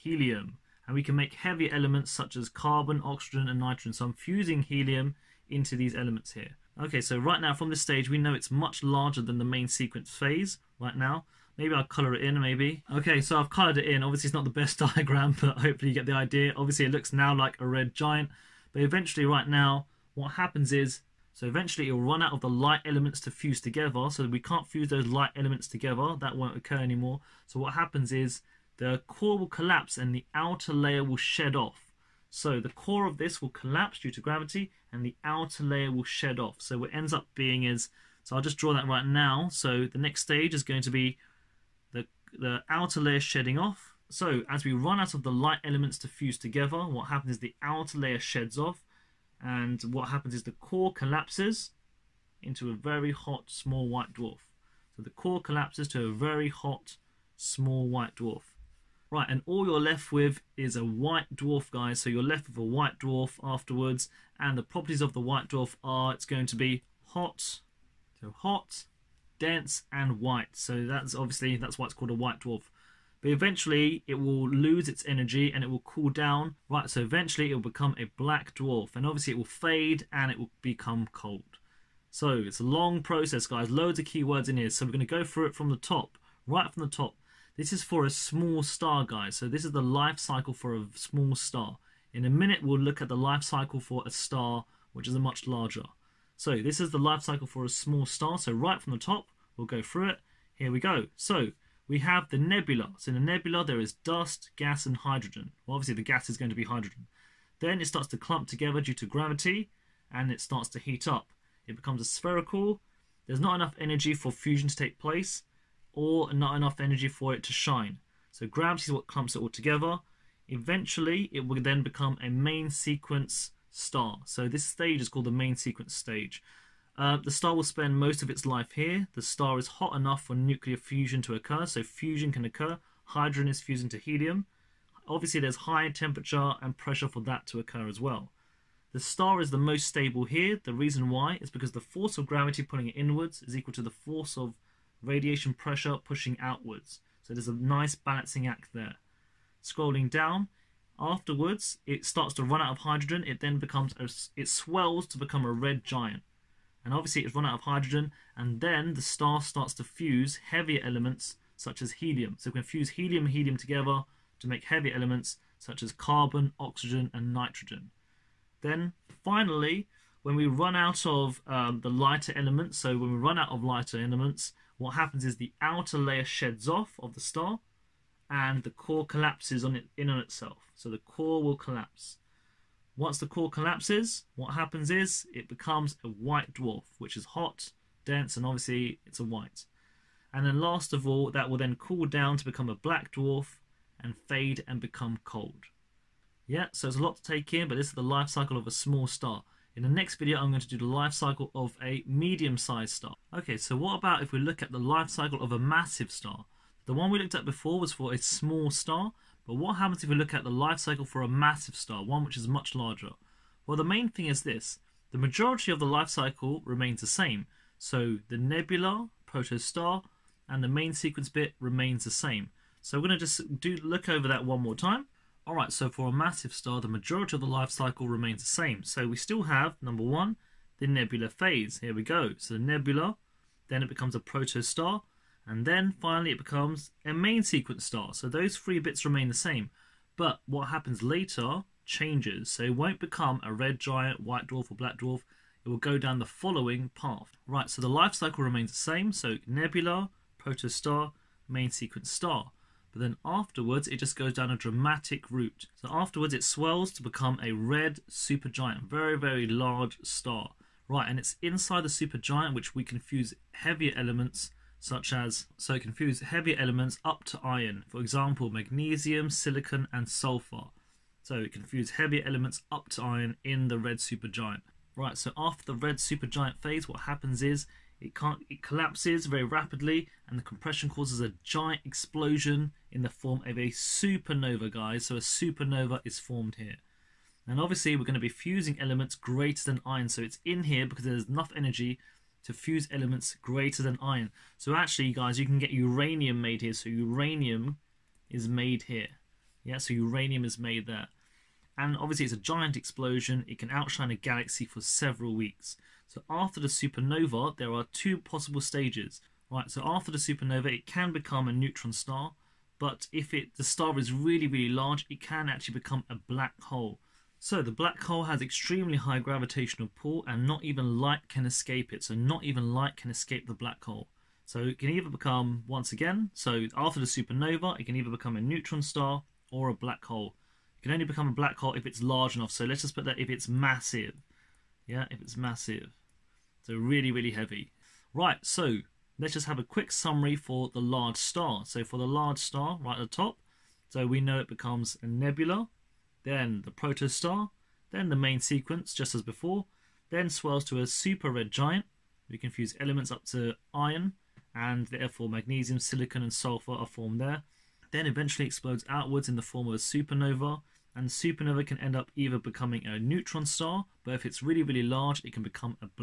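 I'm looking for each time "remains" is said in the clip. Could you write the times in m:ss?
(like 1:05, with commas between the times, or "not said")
3:36, 3:41, 3:48, 3:59, 4:08.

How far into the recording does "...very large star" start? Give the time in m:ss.
4:19.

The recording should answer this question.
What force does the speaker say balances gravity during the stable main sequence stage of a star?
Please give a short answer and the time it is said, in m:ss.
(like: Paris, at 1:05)
radiation pressure, at 2:25.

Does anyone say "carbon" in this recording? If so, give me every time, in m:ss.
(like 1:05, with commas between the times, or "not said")
0:02, 2:45.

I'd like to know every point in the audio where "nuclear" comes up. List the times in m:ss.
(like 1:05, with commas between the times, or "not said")
2:10.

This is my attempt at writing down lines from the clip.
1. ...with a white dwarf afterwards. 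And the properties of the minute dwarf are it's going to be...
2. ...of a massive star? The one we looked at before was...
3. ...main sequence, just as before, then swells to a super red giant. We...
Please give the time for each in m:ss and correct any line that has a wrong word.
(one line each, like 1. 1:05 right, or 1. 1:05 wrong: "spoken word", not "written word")
1. 1:02 wrong: "white", not "minute"
2. 3:25 right
3. 5:48 right.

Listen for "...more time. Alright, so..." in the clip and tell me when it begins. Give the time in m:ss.
3:44.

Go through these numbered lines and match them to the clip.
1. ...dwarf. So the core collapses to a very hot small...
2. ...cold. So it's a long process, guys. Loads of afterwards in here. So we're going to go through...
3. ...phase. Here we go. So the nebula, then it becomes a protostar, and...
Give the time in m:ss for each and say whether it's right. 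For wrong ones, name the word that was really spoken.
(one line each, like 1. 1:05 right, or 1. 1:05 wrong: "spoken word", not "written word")
1. 0:54 right
2. 1:21 wrong: "keywords", not "afterwards"
3. 3:51 right.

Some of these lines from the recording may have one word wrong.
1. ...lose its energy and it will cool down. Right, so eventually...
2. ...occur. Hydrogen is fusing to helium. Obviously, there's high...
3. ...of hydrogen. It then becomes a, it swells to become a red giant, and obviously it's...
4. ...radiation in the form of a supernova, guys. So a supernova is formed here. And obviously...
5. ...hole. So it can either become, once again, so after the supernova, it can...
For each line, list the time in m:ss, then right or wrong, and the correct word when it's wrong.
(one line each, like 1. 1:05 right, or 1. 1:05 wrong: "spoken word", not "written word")
1. 1:14 right
2. 2:12 right
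3. 2:32 right
4. 4:41 wrong: "explosion", not "radiation"
5. 5:23 right.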